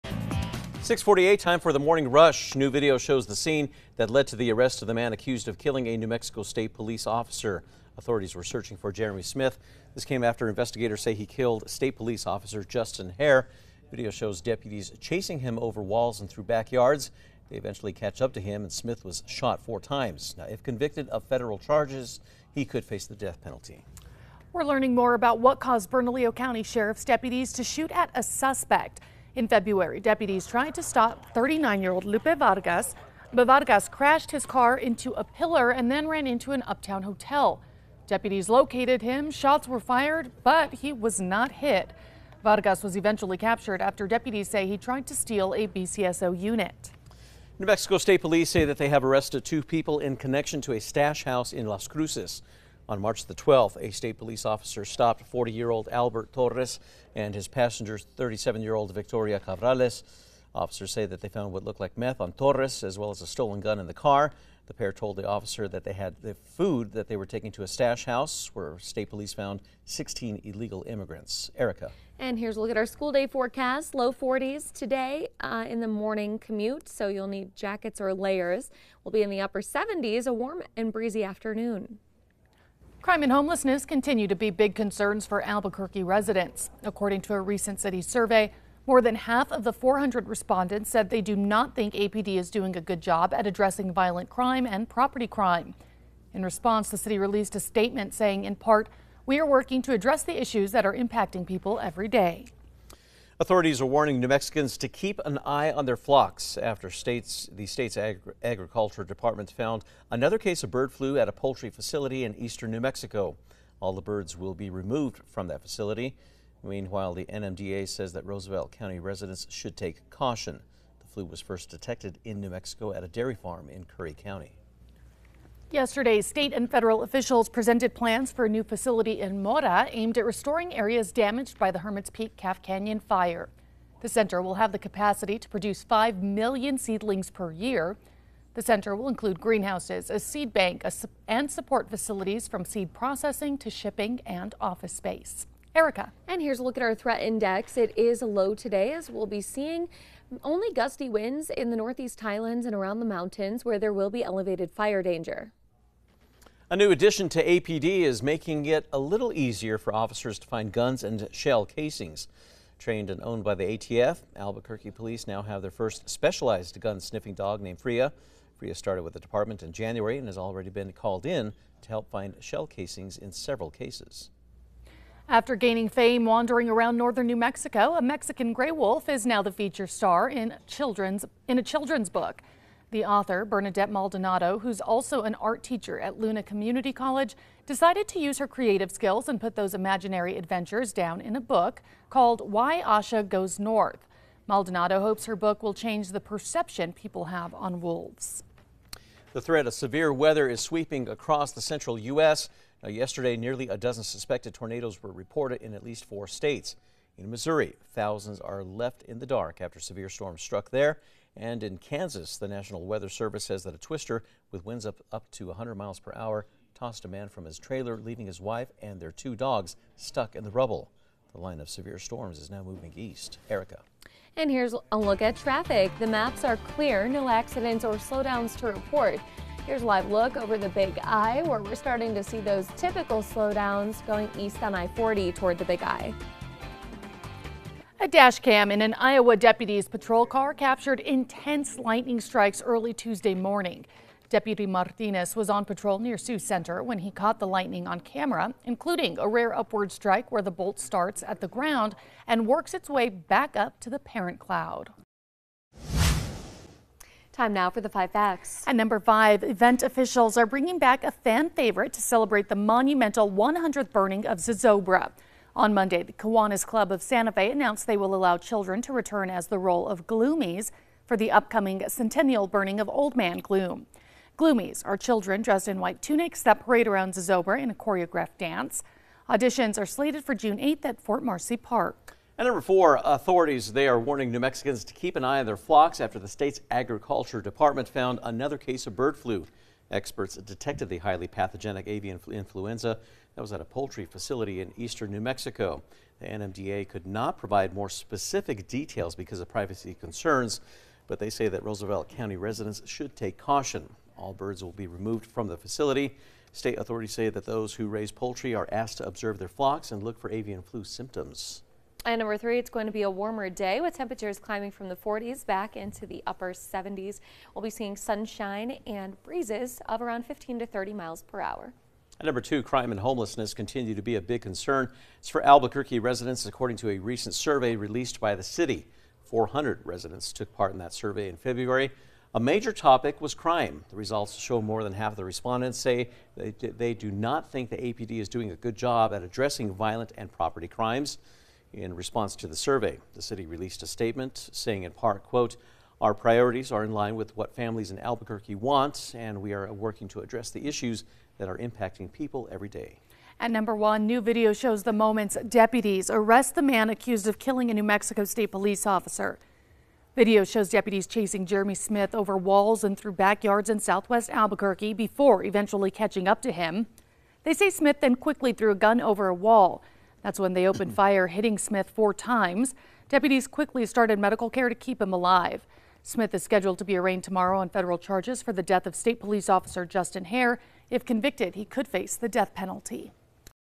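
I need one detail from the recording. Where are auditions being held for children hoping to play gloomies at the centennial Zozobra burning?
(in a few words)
Fort Marcy Park.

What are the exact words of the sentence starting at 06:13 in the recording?
Deputies quickly started medical care to keep him alive.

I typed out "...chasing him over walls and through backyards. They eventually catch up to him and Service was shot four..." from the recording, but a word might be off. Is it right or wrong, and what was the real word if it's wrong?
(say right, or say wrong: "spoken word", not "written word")
wrong: "Smith", not "Service".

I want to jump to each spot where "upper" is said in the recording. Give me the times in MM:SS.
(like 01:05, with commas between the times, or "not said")
01:19, 05:16.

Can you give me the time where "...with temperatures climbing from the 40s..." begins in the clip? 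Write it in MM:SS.
05:13.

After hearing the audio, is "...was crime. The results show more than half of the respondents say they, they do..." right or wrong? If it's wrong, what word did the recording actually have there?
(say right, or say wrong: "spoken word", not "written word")
right.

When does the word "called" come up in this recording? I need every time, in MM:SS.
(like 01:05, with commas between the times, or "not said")
02:50, 03:12.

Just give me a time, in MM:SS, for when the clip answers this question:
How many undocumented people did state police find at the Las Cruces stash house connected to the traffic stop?
01:09.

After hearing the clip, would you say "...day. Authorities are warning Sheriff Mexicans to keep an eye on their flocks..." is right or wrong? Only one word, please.
wrong.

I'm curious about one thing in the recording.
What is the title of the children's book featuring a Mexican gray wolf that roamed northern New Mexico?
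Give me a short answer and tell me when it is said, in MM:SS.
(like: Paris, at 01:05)
Why Asha Goes North, at 03:12.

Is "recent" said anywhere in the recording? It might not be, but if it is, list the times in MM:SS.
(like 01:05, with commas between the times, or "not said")
01:27, 05:26.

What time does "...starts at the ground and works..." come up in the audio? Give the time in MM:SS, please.
04:10.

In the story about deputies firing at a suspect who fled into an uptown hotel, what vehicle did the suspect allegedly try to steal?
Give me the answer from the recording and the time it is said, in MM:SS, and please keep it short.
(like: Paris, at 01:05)
BCSO unit, at 00:45.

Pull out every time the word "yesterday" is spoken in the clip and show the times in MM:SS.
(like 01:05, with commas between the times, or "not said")
02:05, 03:22.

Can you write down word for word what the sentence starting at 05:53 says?
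At number one, new video shows the moments deputies arrest the man accused of killing a New Mexico State police officer.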